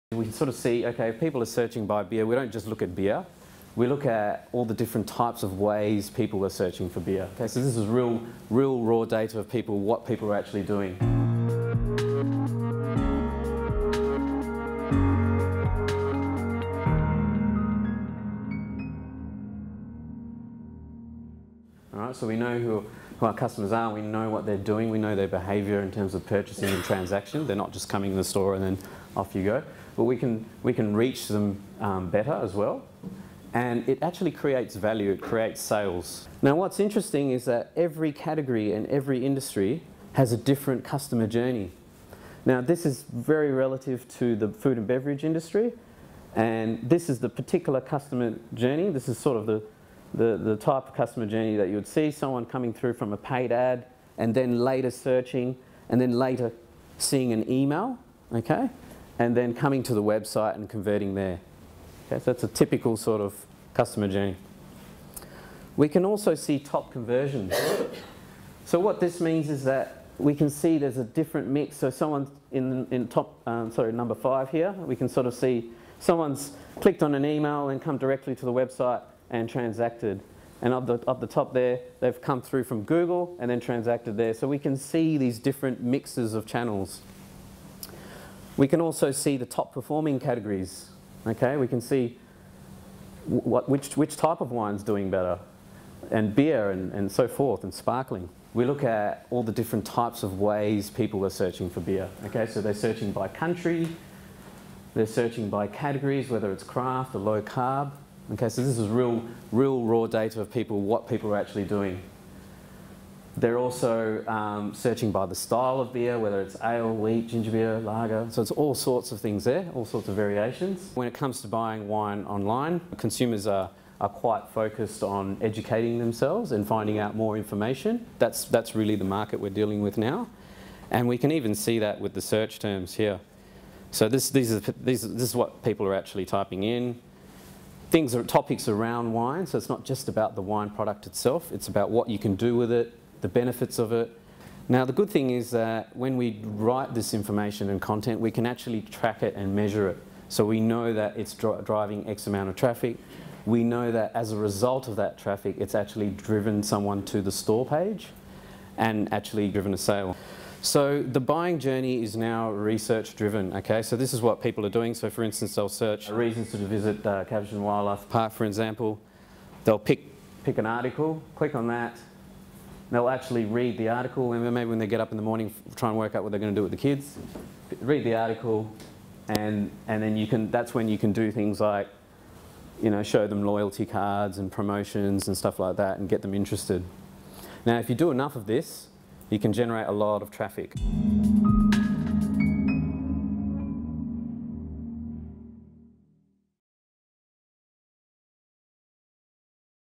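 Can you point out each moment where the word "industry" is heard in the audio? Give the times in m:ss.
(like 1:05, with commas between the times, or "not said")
0:39, 0:45.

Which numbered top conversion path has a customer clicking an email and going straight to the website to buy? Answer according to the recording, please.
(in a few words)
5.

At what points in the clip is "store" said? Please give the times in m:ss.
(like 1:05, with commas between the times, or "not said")
0:28, 2:37.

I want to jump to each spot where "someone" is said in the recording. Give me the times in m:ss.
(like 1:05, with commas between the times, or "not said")
0:52, 1:11, 1:15, 2:36.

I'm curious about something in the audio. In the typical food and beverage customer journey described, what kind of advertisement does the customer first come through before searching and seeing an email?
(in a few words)
paid ad.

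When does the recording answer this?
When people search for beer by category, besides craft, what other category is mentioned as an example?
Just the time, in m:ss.
1:47.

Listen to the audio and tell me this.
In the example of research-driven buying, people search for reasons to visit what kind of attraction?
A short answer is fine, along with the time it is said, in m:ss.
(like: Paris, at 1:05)
Wildlife Park, at 2:47.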